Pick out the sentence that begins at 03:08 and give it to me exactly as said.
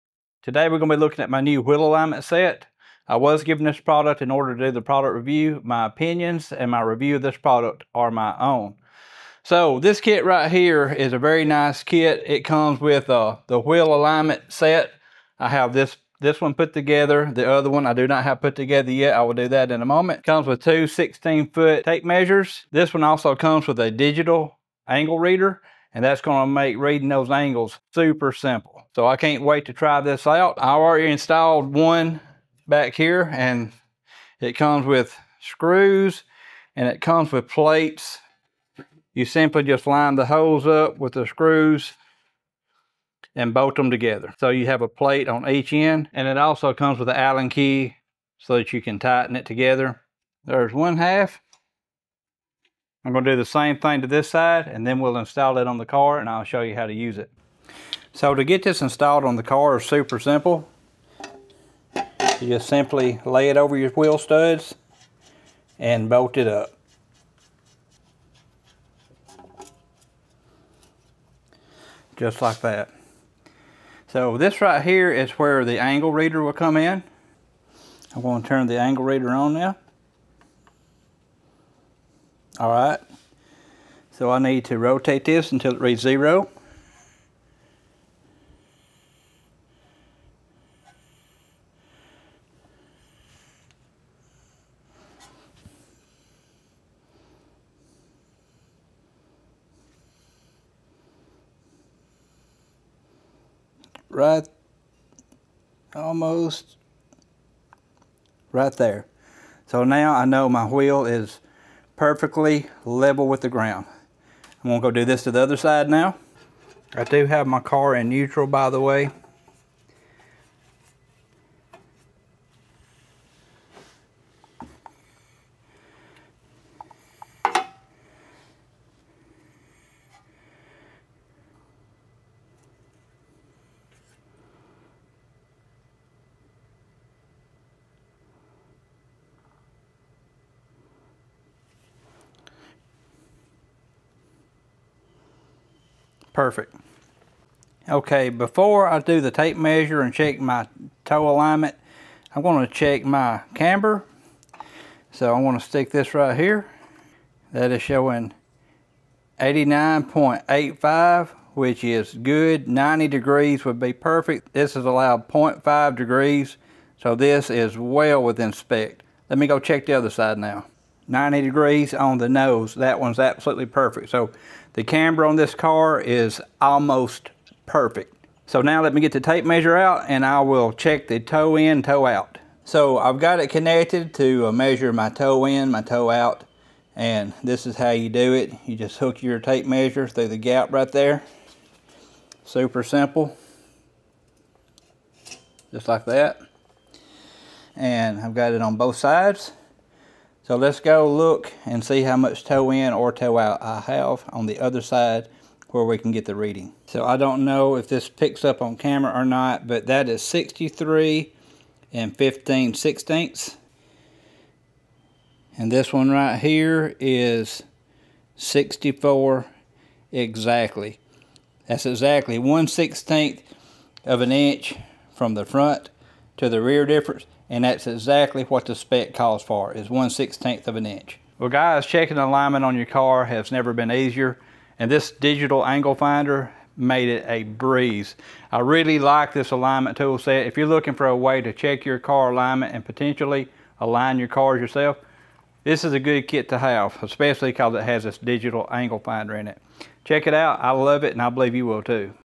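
You just hook your tape measure through the gap right there.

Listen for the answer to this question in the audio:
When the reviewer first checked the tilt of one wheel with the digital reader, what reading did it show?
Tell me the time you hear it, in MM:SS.
02:39.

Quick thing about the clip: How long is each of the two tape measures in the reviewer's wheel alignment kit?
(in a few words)
16 foot.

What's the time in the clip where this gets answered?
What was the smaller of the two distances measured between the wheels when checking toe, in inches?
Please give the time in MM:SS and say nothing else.
03:30.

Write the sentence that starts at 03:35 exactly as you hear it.
And this one right here is 64 exactly.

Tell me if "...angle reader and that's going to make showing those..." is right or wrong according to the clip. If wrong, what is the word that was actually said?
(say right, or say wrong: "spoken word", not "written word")
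wrong: "reading", not "showing".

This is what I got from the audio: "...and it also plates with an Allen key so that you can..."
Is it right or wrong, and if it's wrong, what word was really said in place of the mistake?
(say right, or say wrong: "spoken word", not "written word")
wrong: "comes", not "plates".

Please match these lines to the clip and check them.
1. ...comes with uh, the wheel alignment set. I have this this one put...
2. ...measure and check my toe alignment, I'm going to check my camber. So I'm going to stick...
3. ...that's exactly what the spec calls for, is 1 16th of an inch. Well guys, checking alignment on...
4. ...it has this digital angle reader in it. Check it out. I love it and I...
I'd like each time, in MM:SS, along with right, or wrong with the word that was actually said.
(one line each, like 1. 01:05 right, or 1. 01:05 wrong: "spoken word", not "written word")
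1. 00:12 right
2. 02:29 right
3. 03:47 right
4. 04:07 wrong: "finder", not "reader".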